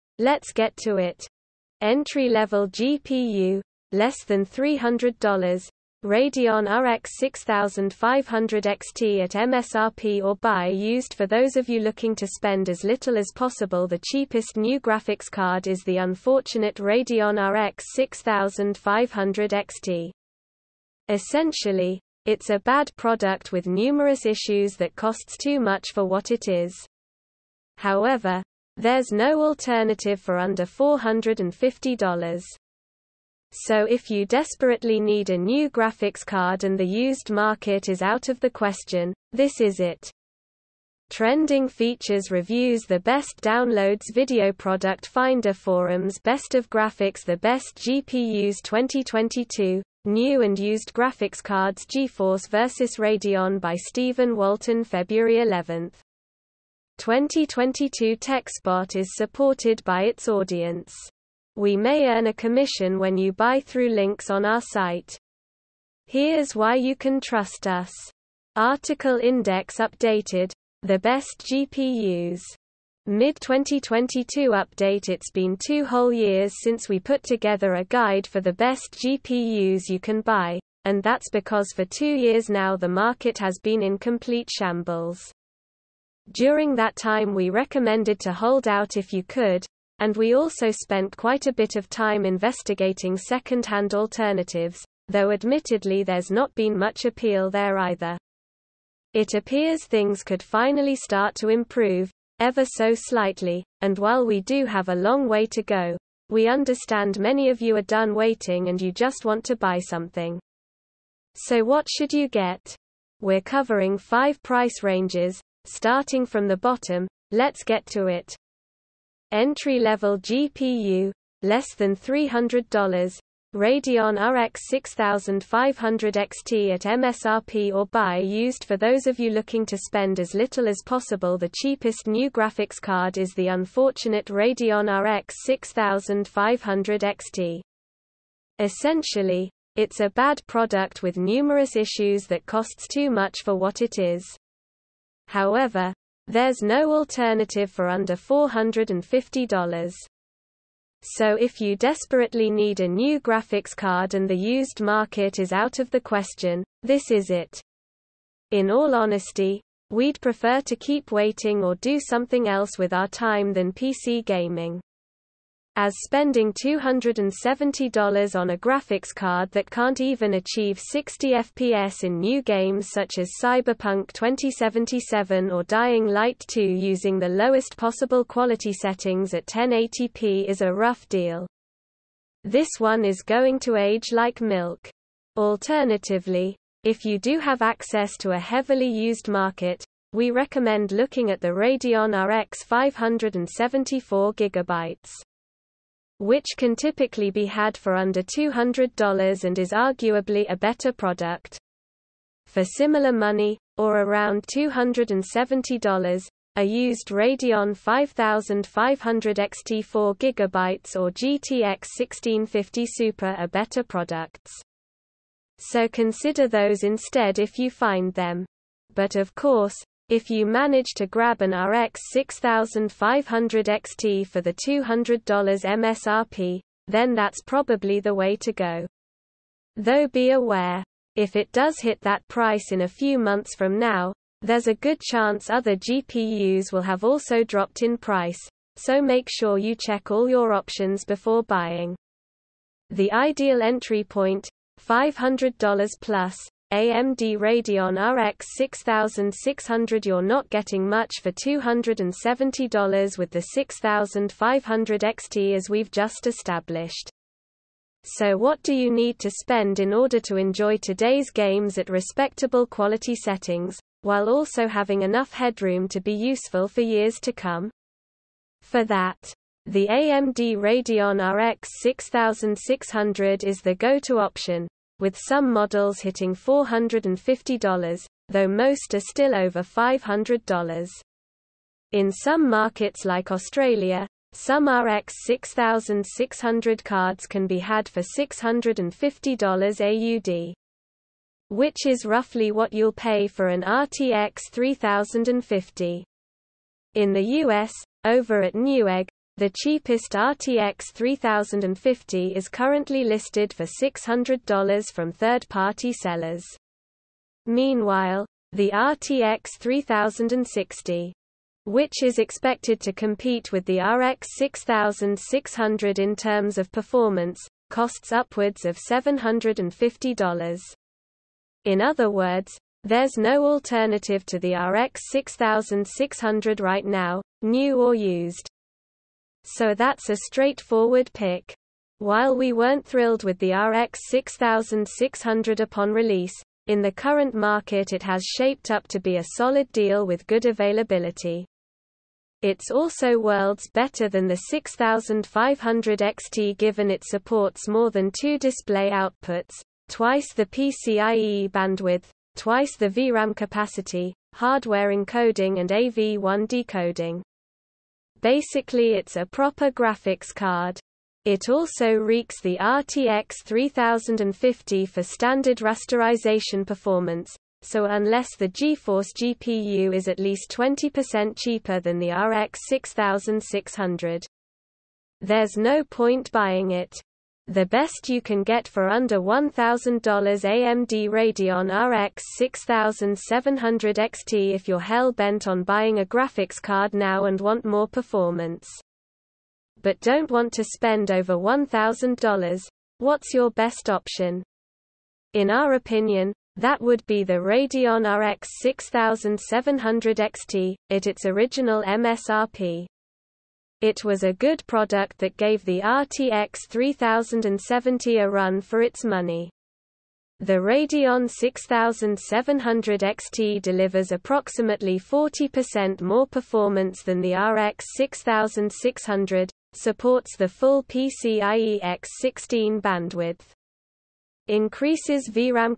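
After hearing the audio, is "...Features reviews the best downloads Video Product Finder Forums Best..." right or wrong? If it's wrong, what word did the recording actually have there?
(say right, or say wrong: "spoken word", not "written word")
right.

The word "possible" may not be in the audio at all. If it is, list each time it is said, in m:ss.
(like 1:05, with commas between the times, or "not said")
0:13, 2:10, 2:57.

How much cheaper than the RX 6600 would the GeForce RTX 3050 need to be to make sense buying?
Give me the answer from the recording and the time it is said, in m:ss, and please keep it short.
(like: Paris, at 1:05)
20%, at 6:10.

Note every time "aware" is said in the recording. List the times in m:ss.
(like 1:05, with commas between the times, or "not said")
3:50.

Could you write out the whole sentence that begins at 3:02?
This one is going to age like milk.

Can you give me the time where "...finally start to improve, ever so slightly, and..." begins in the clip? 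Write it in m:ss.
1:40.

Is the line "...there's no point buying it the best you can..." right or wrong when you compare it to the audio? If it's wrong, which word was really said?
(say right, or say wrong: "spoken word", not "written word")
right.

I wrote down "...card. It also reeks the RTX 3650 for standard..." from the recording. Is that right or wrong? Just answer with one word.
wrong.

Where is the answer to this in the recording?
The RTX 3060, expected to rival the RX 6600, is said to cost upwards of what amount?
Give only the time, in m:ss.
5:18.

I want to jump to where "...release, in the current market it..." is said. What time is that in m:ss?
5:35.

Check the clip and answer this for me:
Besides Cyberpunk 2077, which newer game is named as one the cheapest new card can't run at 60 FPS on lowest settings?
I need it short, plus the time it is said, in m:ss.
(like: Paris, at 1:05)
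Dying Light 2, at 2:55.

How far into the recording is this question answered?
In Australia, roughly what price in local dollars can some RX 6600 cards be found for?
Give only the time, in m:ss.
4:48.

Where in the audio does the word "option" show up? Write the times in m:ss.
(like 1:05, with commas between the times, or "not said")
4:00, 4:34, 6:33.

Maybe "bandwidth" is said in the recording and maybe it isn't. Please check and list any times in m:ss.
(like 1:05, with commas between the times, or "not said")
5:51, 7:02.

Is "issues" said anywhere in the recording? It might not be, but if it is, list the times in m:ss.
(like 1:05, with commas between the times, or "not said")
0:24, 2:21.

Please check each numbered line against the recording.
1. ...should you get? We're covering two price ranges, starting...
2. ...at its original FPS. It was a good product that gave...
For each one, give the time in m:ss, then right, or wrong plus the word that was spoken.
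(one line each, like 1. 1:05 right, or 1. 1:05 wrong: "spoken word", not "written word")
1. 1:51 wrong: "five", not "two"
2. 6:40 wrong: "MSRP", not "FPS".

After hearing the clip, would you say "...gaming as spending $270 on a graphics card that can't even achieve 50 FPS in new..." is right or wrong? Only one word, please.
wrong.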